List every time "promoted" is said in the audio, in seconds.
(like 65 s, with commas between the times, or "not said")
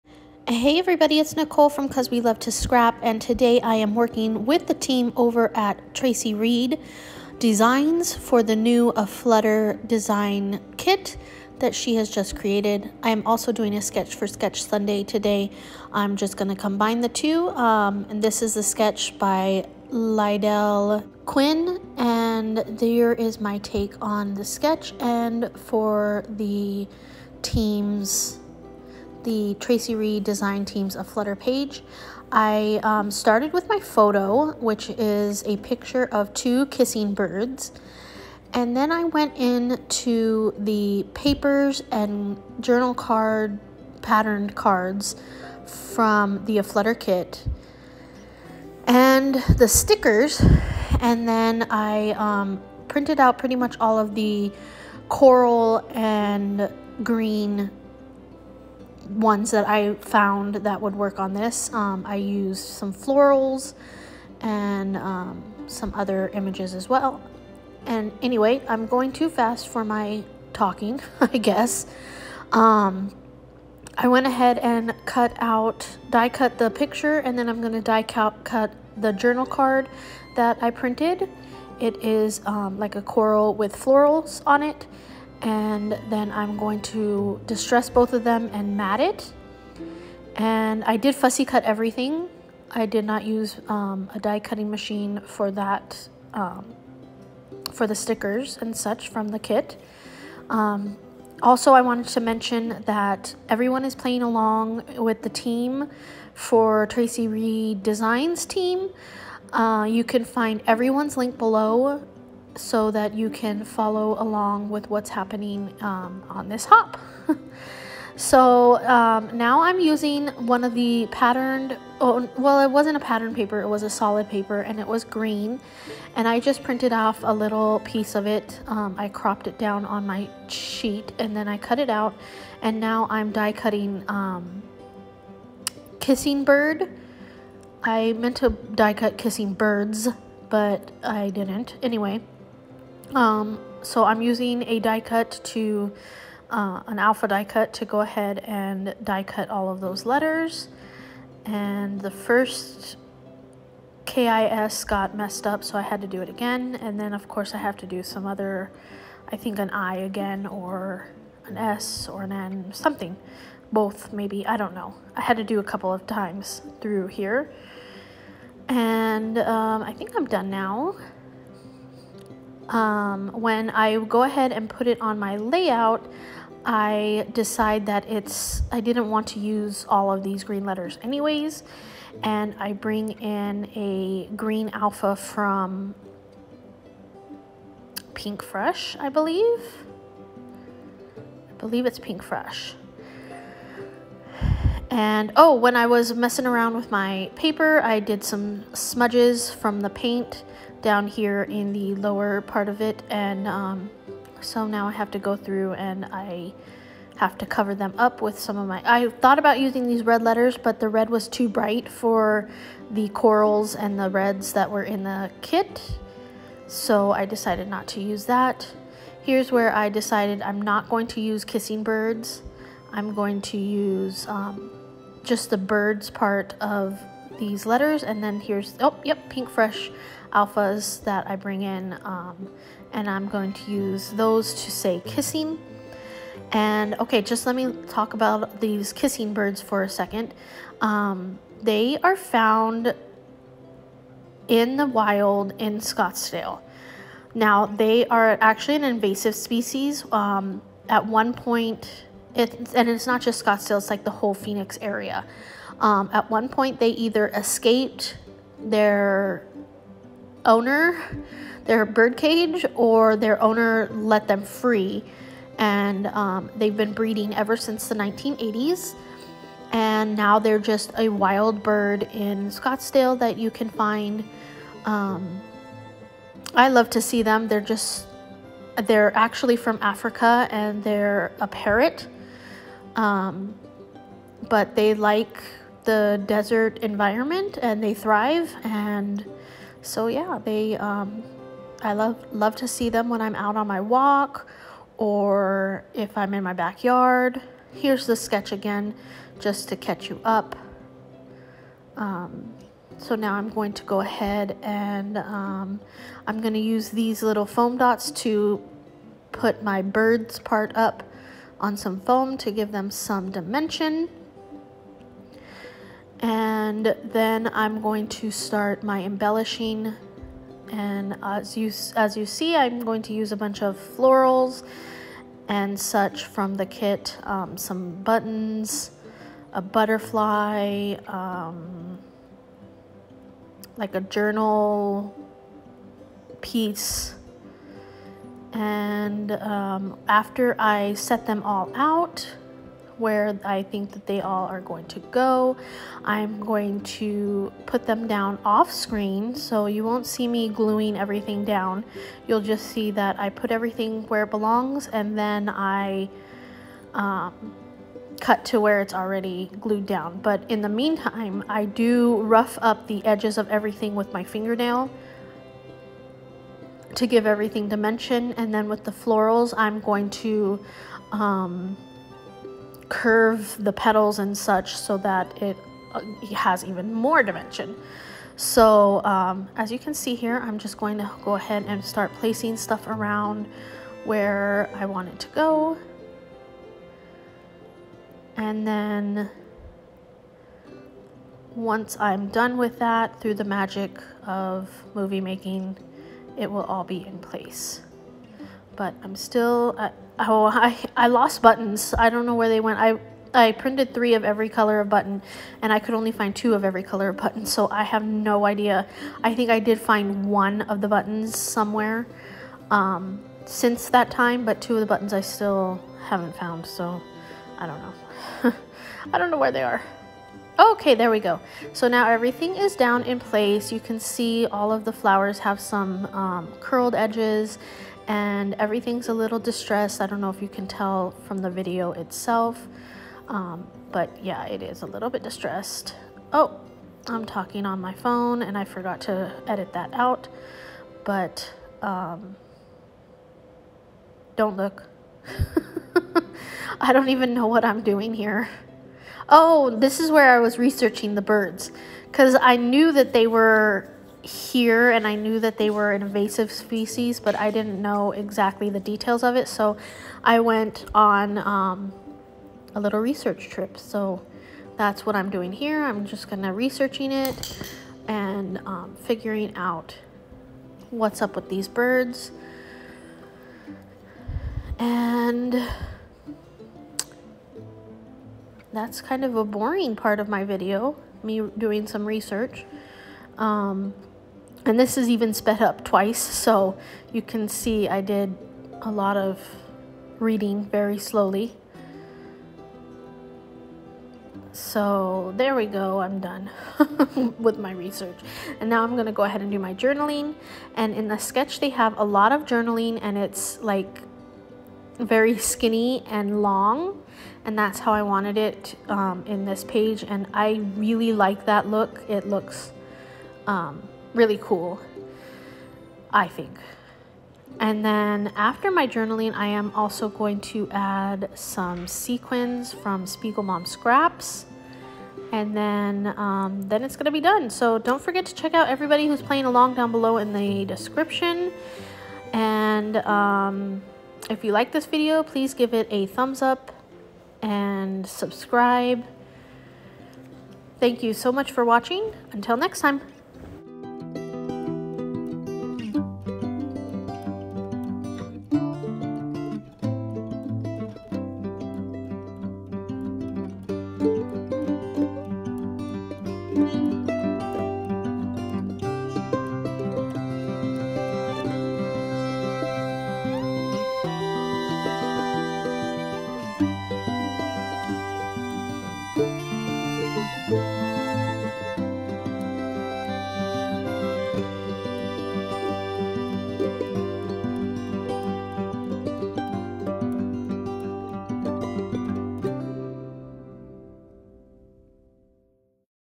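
not said.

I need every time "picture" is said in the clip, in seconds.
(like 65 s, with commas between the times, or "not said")
35 s, 76 s.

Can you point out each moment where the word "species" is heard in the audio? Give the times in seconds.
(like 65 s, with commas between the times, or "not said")
249 s, 456 s.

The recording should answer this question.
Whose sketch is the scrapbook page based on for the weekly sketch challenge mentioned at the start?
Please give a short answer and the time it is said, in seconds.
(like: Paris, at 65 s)
Lydell Quinn, at 19 s.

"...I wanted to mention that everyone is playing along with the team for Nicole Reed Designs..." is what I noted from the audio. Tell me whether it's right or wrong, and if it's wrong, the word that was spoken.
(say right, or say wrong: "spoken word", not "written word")
wrong: "Traci", not "Nicole".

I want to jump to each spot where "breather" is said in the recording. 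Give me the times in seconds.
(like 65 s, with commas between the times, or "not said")
not said.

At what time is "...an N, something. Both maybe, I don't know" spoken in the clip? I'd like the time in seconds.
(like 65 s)
162 s.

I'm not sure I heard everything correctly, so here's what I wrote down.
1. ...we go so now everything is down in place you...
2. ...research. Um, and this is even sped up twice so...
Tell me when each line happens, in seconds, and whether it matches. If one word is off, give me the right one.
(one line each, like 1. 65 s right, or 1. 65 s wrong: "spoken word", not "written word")
1. 421 s right
2. 482 s right.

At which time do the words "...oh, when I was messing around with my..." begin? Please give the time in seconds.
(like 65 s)
195 s.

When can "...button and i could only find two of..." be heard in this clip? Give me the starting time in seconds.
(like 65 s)
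404 s.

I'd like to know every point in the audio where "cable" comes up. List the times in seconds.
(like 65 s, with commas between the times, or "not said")
not said.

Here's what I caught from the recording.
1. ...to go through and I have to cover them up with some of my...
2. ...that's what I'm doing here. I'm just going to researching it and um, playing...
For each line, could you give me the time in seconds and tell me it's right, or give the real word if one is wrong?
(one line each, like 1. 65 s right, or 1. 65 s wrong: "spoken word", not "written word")
1. 205 s right
2. 464 s wrong: "figuring", not "playing".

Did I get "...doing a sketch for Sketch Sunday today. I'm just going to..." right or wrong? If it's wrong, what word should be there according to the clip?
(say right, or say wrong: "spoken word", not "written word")
right.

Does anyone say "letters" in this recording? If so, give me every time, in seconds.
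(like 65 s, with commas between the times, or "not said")
150 s, 180 s, 210 s, 227 s.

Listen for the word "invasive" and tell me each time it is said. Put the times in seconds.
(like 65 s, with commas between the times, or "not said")
248 s, 456 s.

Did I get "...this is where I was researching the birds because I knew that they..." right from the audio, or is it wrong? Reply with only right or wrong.
right.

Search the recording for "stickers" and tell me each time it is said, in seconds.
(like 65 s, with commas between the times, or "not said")
49 s, 97 s.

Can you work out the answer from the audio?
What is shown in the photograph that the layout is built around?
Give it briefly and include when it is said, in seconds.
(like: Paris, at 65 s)
Two kissing birds, at 36 s.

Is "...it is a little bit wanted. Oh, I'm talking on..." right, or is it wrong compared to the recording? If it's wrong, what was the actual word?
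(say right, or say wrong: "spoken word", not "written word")
wrong: "distressed", not "wanted".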